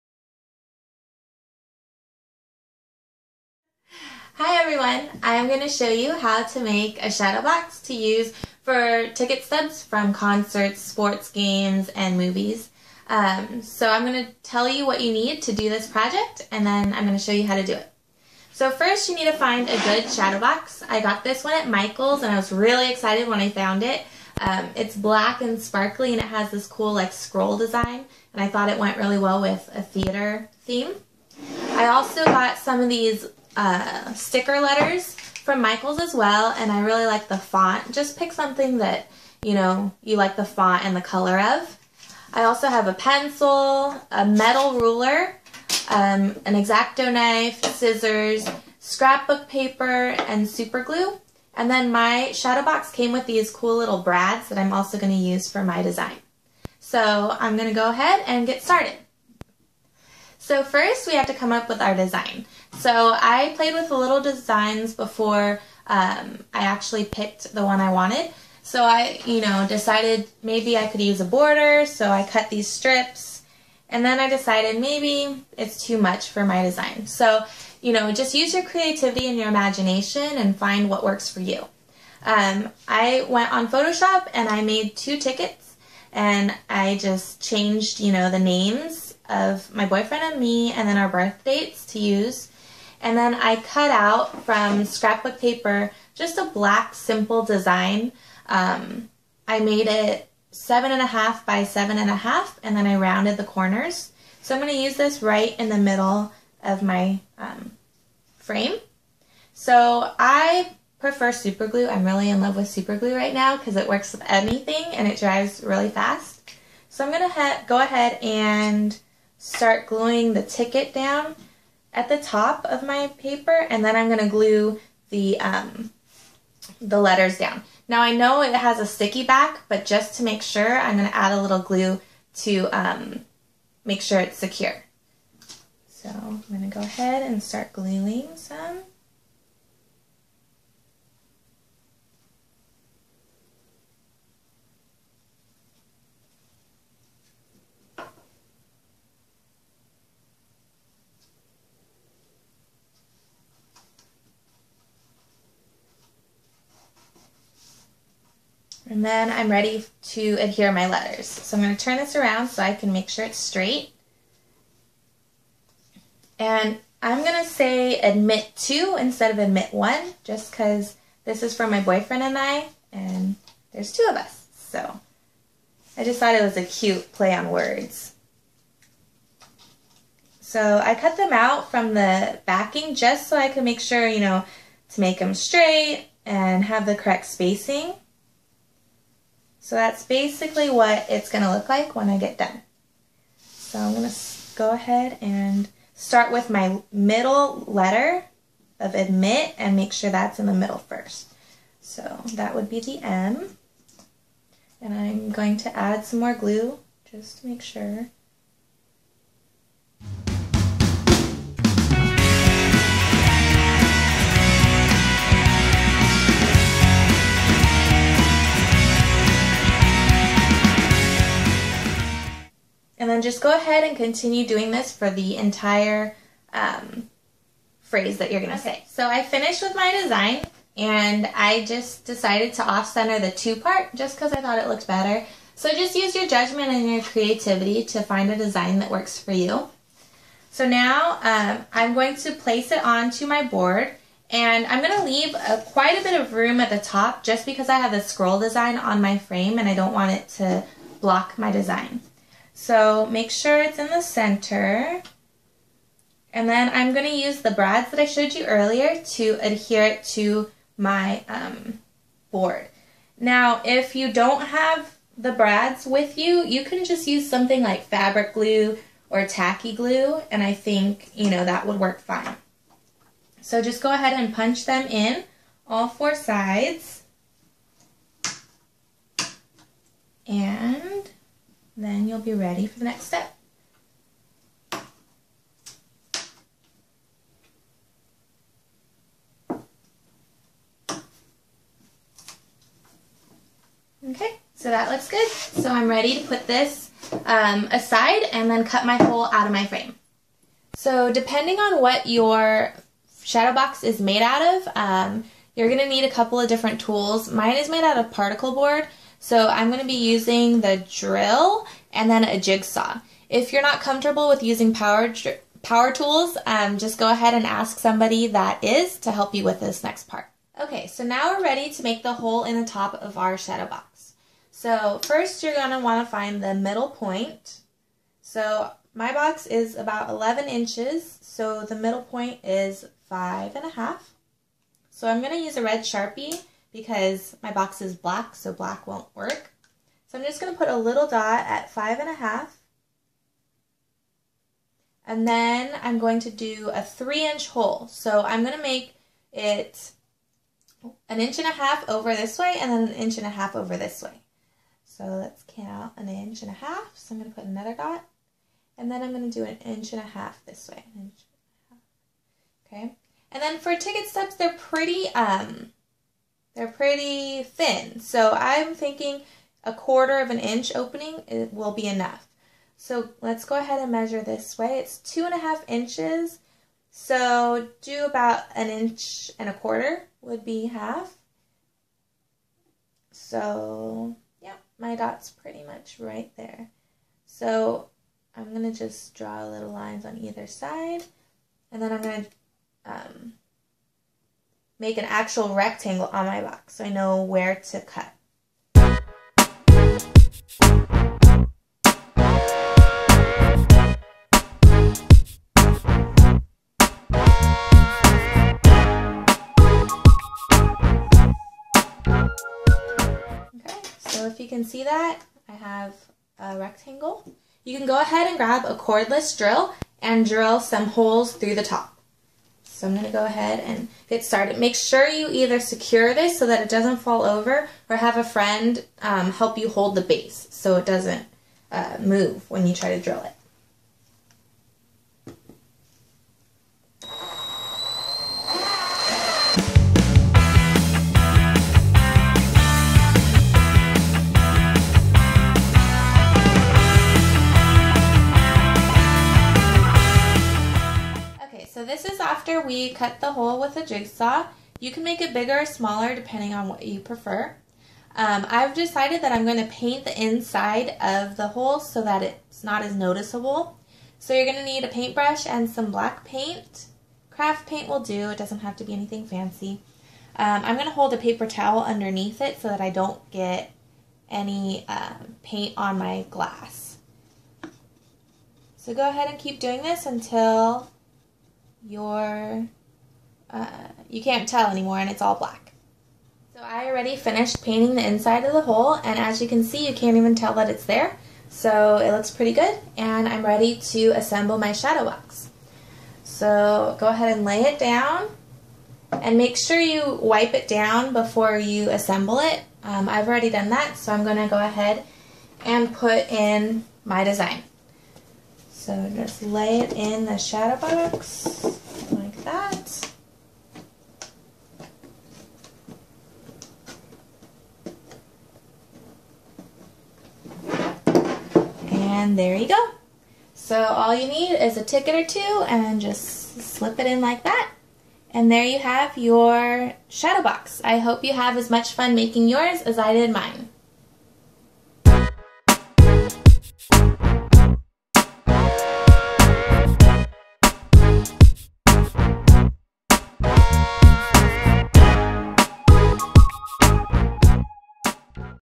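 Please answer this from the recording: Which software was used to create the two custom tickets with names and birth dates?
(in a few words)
Photoshop.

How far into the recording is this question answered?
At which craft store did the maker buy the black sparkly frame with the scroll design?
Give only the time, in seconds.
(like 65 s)
21 s.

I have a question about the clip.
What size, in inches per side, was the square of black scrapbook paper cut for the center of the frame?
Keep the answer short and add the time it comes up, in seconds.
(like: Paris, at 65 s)
7.5 by 7.5, at 100 s.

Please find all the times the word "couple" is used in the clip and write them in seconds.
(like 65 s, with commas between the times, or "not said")
306 s.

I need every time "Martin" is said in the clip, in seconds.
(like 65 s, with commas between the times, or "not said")
not said.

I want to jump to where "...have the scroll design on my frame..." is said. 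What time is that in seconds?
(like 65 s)
247 s.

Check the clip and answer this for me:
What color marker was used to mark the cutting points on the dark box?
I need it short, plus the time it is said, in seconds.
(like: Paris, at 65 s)
Red, at 335 s.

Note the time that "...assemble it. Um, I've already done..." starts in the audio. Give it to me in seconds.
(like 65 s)
501 s.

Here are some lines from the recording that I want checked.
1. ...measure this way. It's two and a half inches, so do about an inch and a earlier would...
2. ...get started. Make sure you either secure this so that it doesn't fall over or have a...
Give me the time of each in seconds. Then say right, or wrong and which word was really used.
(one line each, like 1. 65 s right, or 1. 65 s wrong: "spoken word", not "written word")
1. 373 s wrong: "quarter", not "earlier"
2. 424 s right.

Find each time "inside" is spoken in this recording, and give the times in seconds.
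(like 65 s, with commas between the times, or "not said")
460 s, 488 s.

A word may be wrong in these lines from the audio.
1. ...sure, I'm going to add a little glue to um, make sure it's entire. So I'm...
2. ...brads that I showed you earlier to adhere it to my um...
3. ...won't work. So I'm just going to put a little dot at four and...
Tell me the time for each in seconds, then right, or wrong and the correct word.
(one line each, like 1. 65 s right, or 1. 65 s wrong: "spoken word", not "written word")
1. 130 s wrong: "secure", not "entire"
2. 257 s right
3. 338 s wrong: "five", not "four".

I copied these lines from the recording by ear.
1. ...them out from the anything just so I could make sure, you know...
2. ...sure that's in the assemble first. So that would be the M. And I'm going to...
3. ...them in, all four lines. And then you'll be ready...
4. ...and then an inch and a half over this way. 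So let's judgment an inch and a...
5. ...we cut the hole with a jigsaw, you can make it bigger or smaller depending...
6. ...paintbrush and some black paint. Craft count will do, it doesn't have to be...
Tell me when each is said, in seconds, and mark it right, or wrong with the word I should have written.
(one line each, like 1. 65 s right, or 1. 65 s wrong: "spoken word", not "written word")
1. 181 s wrong: "backing", not "anything"
2. 199 s wrong: "middle", not "assemble"
3. 274 s wrong: "sides", not "lines"
4. 352 s wrong: "count", not "judgment"
5. 452 s right
6. 464 s wrong: "paint", not "count".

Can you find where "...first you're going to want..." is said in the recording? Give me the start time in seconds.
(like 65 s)
325 s.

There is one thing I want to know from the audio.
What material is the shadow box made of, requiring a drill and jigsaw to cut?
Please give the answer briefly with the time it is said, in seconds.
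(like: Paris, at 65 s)
Particle board, at 308 s.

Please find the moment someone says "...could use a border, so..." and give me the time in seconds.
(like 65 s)
70 s.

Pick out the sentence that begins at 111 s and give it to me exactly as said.
I'm really in love with super glue right now because it works with anything and it dries really fast.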